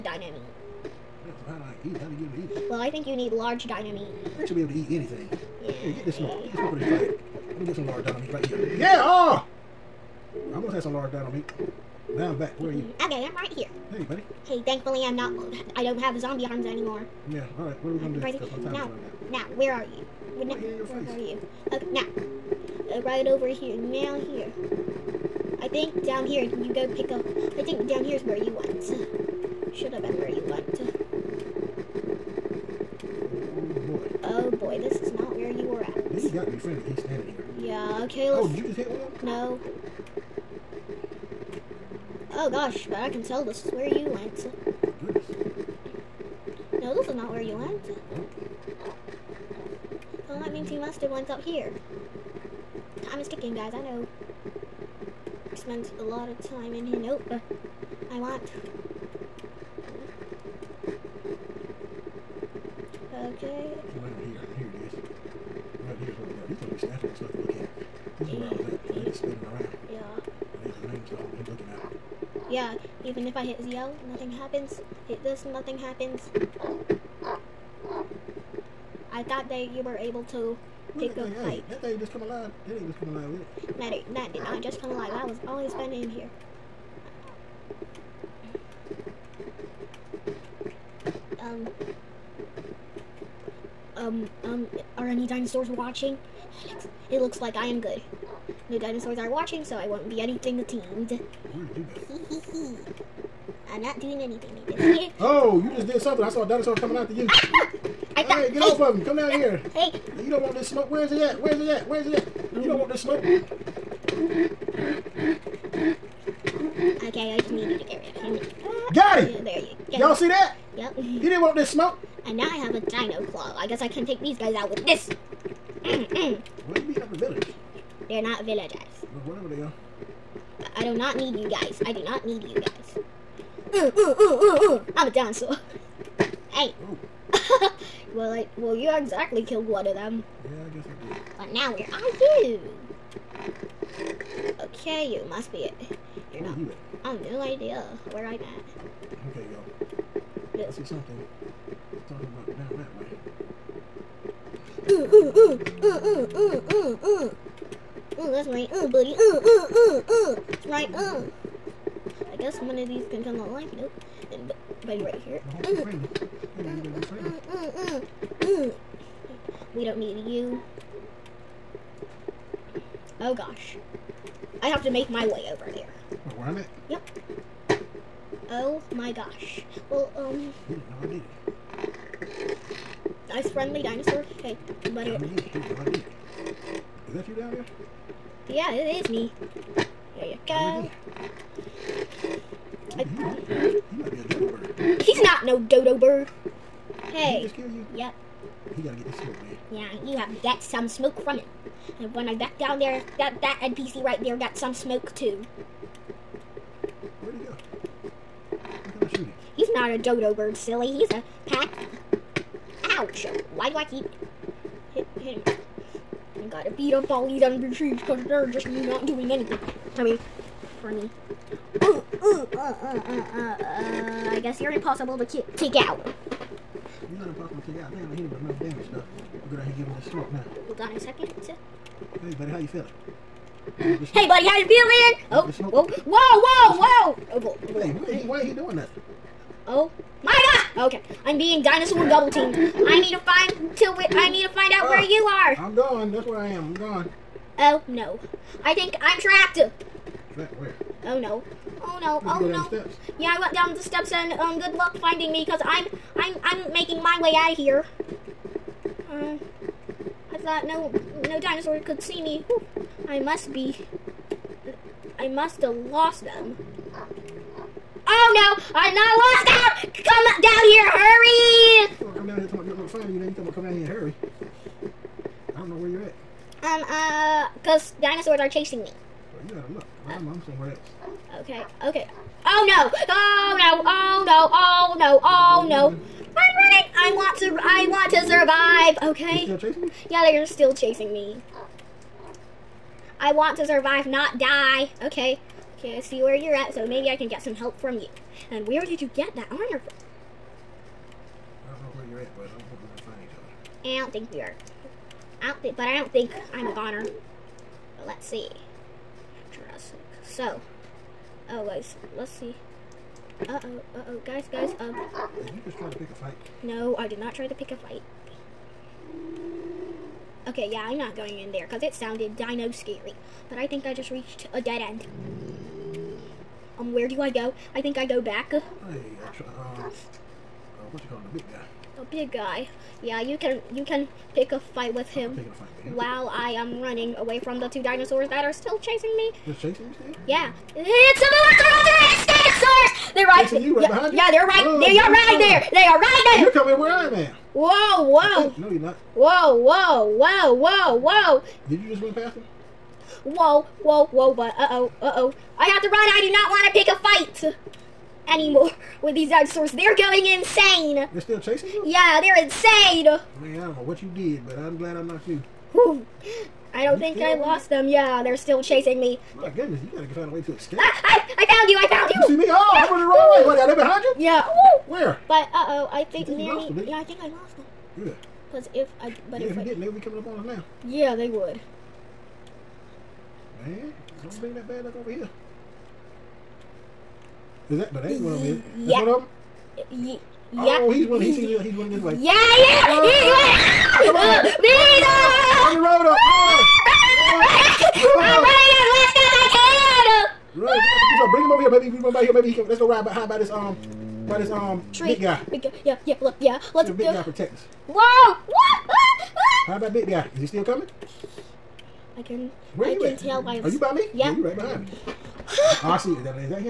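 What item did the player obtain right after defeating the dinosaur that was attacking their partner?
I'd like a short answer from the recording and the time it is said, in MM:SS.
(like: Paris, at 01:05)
Dino claw, at 02:02.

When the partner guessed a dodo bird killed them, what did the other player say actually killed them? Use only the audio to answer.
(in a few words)
A pack.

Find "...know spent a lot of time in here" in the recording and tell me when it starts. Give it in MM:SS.
00:53.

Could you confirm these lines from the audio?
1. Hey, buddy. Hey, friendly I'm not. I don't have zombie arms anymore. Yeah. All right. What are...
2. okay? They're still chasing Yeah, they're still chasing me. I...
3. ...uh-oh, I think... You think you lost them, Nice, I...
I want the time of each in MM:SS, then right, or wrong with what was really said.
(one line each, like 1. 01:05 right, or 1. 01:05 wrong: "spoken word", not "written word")
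1. 00:13 wrong: "thankfully", not "friendly"
2. 04:49 right
3. 06:15 wrong: "Yeah", not "Nice".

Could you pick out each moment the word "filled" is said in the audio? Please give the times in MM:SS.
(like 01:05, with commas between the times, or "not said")
not said.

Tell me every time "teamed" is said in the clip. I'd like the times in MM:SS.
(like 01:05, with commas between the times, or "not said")
01:40, 04:02.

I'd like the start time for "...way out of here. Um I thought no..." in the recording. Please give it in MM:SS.
04:17.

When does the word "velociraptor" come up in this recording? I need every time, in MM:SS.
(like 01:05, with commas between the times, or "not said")
05:41.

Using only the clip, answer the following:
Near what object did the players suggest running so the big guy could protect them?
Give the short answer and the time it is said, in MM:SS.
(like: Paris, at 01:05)
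Tree, at 06:44.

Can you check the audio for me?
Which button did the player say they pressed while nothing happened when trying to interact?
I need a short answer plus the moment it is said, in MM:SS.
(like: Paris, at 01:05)
ZL, at 01:13.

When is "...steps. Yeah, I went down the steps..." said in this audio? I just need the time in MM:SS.
04:12.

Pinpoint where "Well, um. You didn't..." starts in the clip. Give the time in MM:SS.
02:59.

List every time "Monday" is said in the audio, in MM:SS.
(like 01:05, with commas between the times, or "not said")
not said.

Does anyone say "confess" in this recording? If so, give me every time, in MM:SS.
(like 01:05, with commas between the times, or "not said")
not said.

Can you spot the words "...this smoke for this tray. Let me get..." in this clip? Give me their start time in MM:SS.
00:06.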